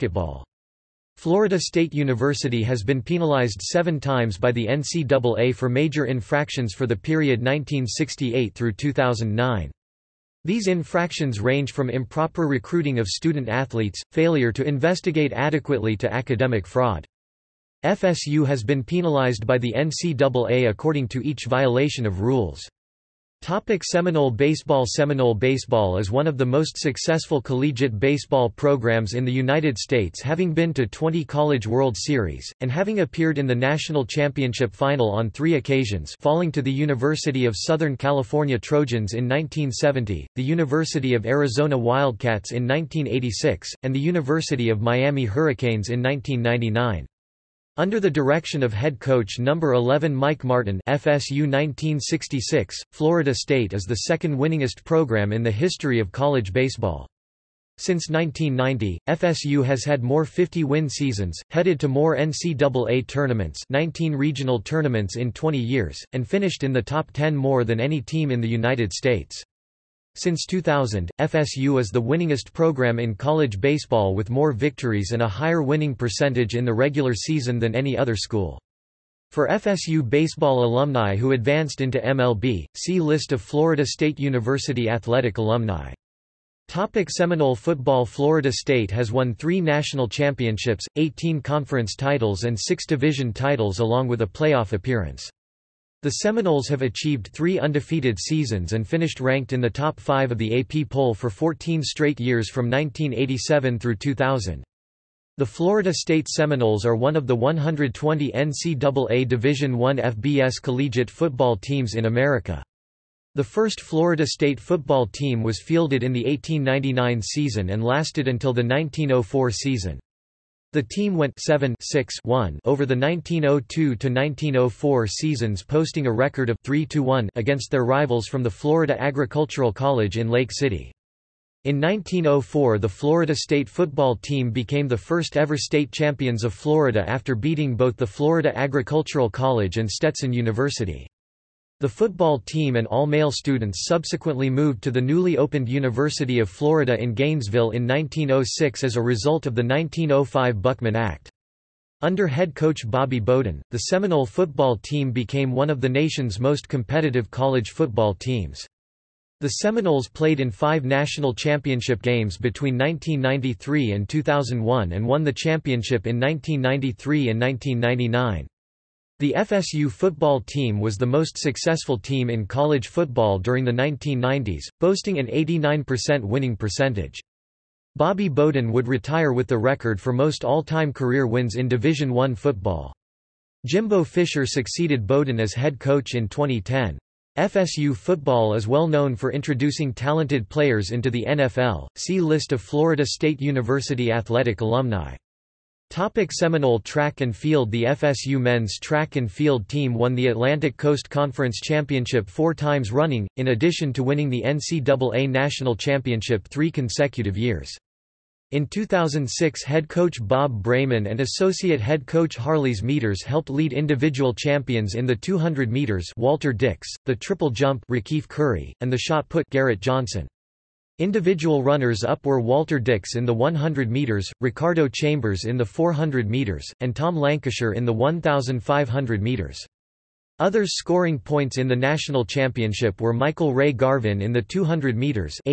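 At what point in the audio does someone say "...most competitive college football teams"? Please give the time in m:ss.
2:36.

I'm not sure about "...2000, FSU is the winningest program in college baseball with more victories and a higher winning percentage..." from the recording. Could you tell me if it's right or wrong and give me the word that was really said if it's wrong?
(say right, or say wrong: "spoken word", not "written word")
right.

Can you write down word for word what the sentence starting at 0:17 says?
FSU has been penalized by the NCAA according to each violation of rules.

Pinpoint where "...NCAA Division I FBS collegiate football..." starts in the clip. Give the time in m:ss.
1:48.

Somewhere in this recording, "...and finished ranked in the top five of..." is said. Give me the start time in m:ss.
1:38.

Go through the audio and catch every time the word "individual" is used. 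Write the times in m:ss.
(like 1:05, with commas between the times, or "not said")
3:33, 3:40.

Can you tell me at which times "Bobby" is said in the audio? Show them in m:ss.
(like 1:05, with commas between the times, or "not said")
2:32, 2:57.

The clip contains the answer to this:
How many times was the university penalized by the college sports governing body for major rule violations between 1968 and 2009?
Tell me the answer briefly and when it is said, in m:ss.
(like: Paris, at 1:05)
7, at 0:03.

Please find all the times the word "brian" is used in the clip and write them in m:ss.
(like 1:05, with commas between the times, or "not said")
not said.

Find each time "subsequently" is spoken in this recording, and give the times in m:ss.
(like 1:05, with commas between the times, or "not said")
2:23.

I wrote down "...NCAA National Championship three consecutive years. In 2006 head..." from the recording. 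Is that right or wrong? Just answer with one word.
right.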